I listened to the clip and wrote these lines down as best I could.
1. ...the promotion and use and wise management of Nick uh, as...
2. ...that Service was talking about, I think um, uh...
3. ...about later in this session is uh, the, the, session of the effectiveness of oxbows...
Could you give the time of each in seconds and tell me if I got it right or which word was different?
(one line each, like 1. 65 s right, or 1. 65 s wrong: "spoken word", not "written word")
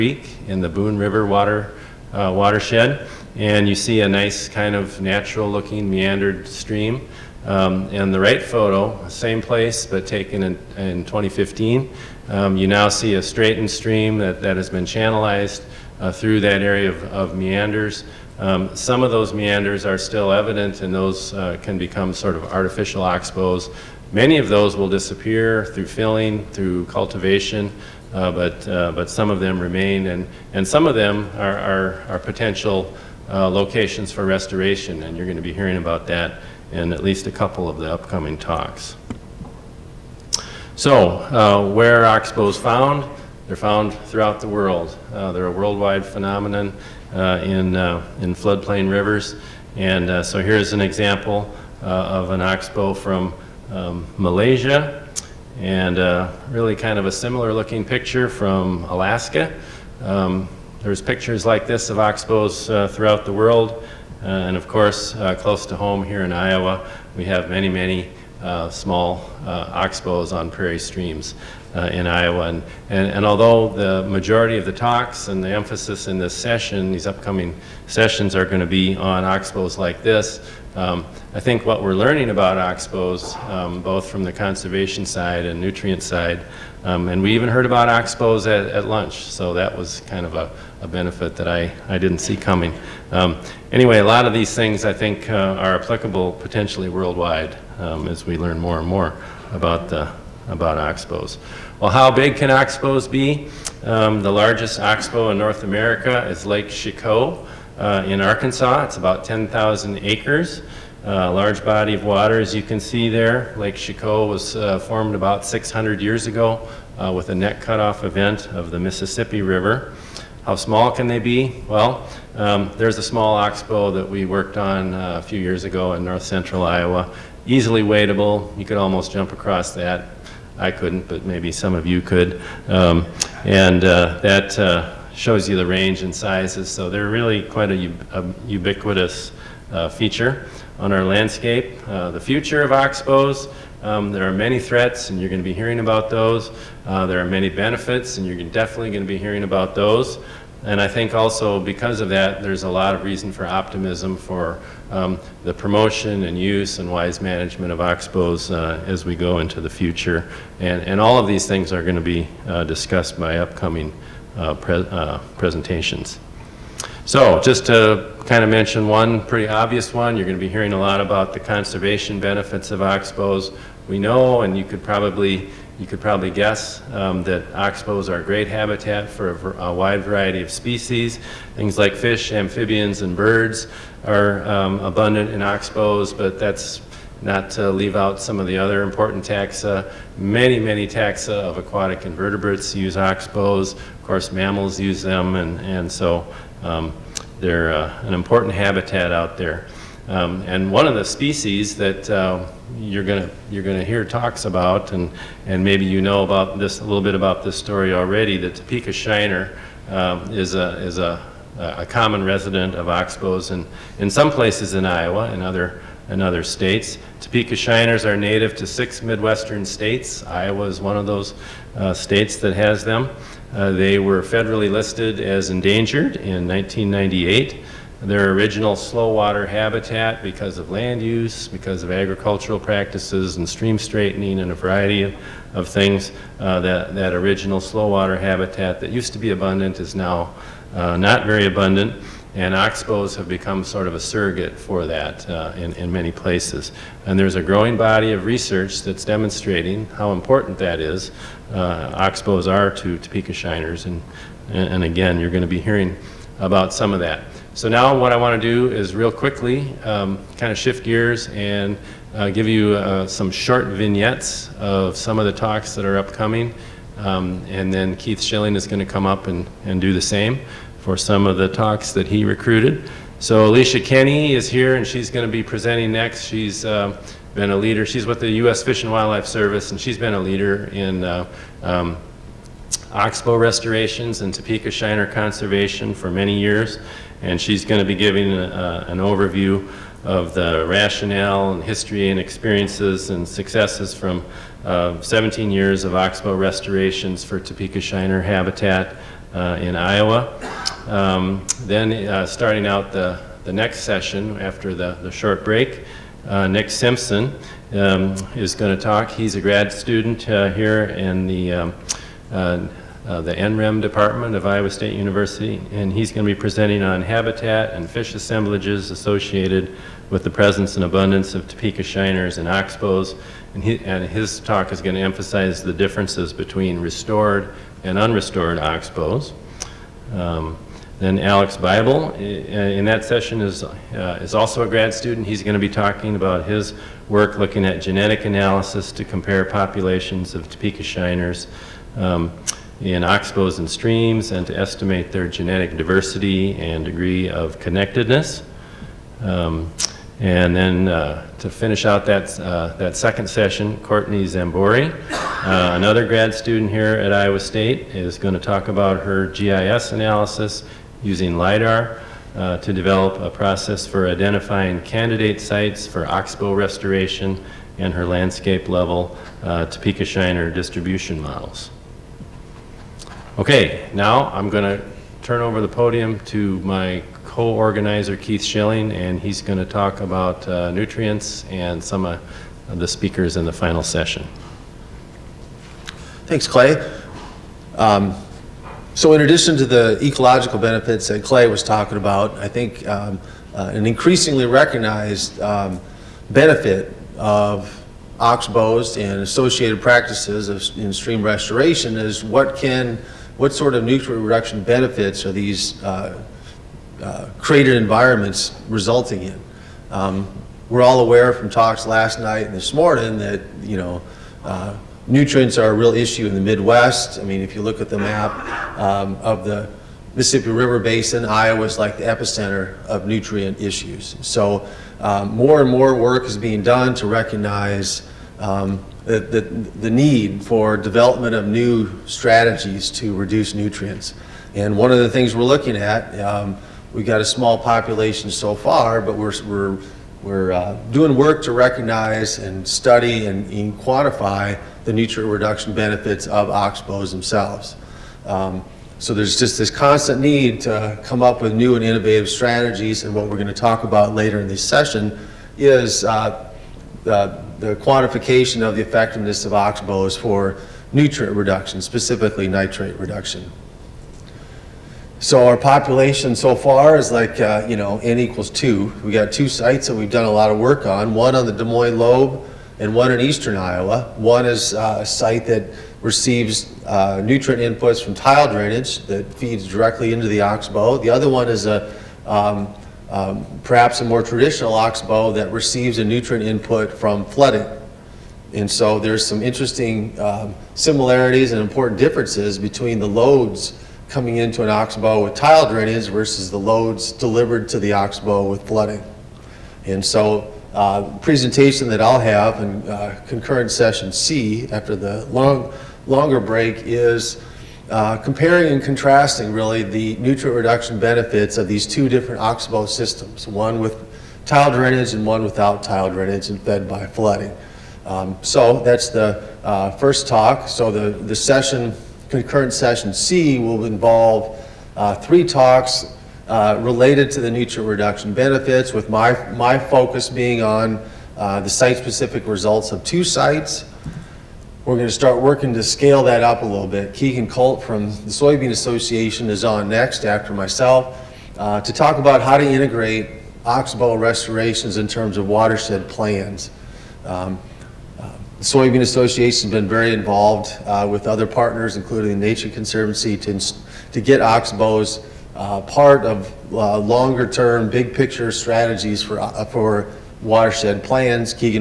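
1. 155 s wrong: "Oxbows", not "Nick"
2. 391 s wrong: "Clay", not "Service"
3. 453 s wrong: "quantification", not "session".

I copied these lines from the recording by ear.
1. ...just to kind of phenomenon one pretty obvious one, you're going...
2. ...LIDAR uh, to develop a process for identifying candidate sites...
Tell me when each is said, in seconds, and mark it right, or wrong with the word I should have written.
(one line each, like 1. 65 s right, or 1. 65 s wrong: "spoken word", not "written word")
1. 167 s wrong: "mention", not "phenomenon"
2. 361 s right.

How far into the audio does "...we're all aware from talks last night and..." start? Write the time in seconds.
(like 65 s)
410 s.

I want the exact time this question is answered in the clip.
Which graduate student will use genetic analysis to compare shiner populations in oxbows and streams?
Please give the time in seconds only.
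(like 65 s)
331 s.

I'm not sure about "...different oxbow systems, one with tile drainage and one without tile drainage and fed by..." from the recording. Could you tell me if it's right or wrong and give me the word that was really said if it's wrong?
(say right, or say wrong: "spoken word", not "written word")
right.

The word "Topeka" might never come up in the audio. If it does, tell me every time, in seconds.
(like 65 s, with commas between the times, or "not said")
208 s, 217 s, 252 s, 284 s, 297 s, 321 s, 340 s, 369 s.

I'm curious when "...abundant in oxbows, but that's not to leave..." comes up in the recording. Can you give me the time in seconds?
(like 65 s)
184 s.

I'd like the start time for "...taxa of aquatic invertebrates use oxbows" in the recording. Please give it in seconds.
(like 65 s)
190 s.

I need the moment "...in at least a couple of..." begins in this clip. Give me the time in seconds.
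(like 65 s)
36 s.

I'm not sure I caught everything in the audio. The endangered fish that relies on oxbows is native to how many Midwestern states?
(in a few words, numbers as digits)
6.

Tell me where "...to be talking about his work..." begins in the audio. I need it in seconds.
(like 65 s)
335 s.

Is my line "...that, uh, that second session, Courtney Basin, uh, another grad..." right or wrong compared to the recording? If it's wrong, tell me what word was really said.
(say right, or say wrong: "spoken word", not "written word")
wrong: "Zambory", not "Basin".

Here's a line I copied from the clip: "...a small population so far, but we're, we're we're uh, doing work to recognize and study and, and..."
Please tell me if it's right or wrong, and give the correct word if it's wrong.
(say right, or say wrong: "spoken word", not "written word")
right.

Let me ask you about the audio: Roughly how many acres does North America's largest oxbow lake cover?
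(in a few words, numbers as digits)
10,000 acres.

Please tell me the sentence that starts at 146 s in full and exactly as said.
Uh, there are many benefits, and you're definitely going to be hearing about those.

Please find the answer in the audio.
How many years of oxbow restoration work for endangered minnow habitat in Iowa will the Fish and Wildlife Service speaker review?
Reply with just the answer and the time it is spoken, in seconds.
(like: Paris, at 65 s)
17, at 295 s.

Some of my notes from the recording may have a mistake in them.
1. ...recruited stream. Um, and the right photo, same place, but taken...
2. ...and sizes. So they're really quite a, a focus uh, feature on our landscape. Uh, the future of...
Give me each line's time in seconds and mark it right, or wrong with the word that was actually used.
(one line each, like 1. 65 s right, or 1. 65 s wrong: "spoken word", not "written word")
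1. 5 s wrong: "meandered", not "recruited"
2. 136 s wrong: "ubiquitous", not "focus".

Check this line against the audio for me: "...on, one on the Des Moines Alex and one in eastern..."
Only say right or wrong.
wrong.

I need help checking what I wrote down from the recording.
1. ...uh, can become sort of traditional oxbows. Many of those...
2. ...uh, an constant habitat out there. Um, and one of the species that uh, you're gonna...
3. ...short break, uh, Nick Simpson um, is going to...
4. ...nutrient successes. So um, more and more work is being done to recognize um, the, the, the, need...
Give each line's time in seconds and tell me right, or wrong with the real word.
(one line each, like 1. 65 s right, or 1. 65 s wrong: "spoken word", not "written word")
1. 21 s wrong: "artificial", not "traditional"
2. 197 s wrong: "important", not "constant"
3. 305 s right
4. 423 s wrong: "issues", not "successes".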